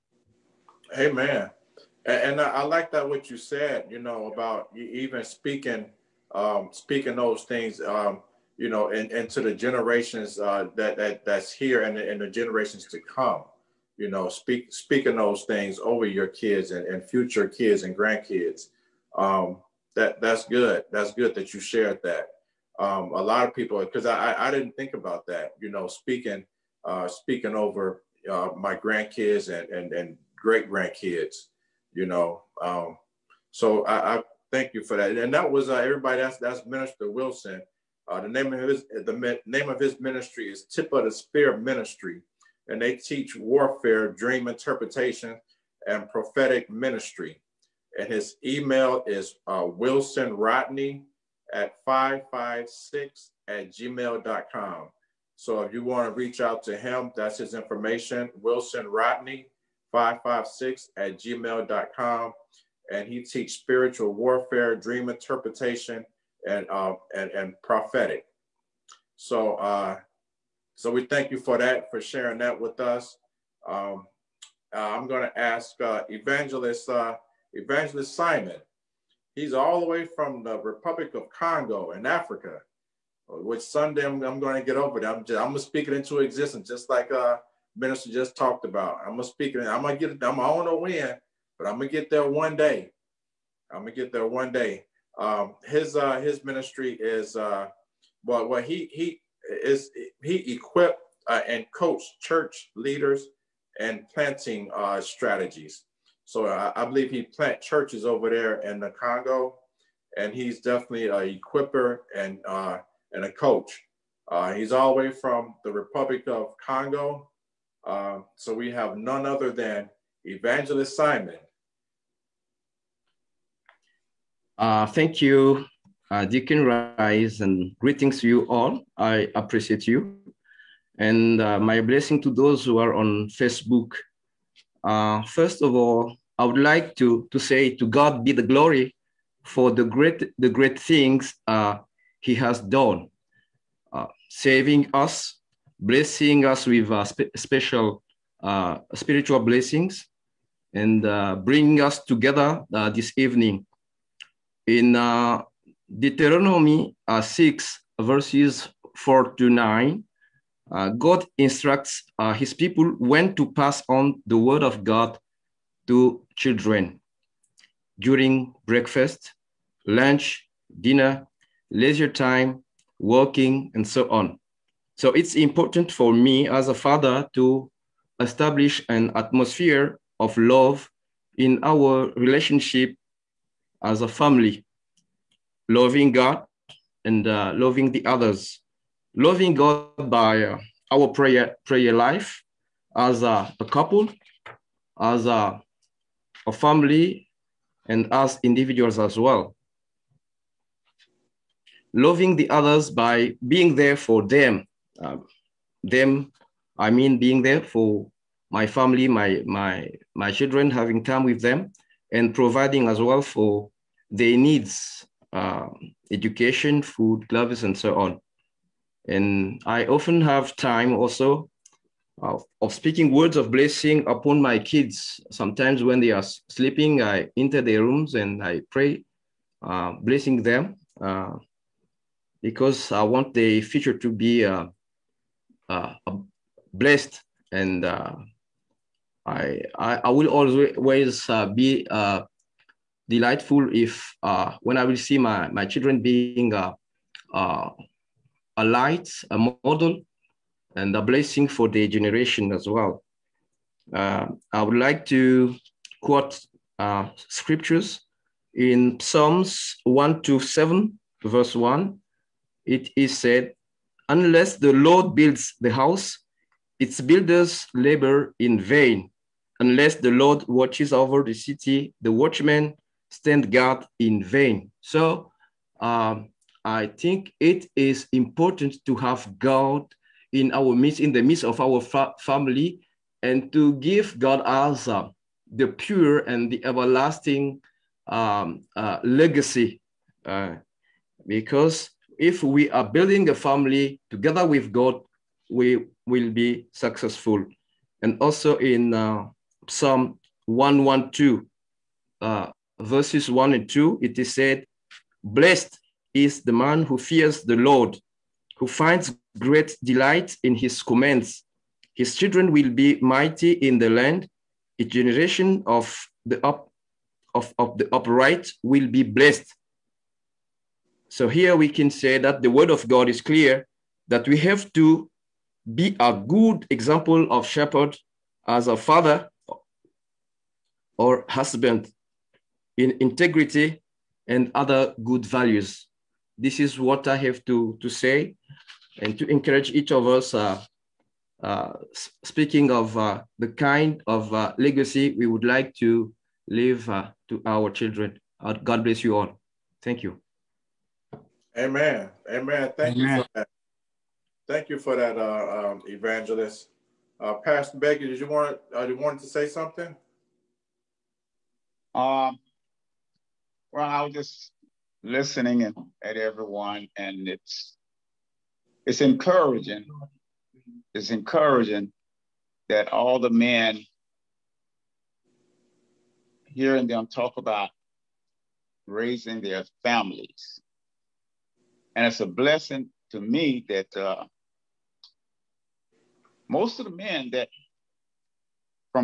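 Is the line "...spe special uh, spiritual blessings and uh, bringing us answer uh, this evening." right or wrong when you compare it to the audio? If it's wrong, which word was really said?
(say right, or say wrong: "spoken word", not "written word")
wrong: "together", not "answer".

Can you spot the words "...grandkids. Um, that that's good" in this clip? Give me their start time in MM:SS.
00:17.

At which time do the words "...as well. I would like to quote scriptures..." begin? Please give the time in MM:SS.
04:12.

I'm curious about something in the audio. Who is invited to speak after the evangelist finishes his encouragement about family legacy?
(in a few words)
Pastor Baker.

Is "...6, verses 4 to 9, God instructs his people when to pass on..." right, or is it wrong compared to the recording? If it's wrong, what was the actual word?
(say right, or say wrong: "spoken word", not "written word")
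right.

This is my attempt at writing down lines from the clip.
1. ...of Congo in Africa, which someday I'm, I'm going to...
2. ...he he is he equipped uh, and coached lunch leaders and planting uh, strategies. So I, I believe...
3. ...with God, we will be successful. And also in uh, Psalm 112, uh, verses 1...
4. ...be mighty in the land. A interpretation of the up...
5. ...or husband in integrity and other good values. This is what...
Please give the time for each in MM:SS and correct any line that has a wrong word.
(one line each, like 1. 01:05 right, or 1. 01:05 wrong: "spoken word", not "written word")
1. 01:21 right
2. 01:38 wrong: "church", not "lunch"
3. 04:54 right
4. 05:12 wrong: "generation", not "interpretation"
5. 05:30 right.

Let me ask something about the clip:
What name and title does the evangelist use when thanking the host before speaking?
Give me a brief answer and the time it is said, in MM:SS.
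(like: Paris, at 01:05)
Deacon Rice, at 02:06.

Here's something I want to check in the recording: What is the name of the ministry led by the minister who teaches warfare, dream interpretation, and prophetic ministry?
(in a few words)
Tip of the Spear Ministry.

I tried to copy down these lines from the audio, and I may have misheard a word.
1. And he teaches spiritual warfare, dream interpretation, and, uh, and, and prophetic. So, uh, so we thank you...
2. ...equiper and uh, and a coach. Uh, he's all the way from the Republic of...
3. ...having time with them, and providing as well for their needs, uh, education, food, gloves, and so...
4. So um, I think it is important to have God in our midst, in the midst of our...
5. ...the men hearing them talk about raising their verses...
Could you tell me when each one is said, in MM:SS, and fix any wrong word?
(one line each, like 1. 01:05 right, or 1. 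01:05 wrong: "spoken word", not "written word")
1. 01:02 right
2. 01:51 right
3. 03:30 right
4. 04:34 right
5. 06:13 wrong: "families", not "verses".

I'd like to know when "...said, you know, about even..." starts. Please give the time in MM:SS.
00:03.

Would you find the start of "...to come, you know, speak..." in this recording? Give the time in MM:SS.
00:12.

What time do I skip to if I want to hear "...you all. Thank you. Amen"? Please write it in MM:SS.
05:49.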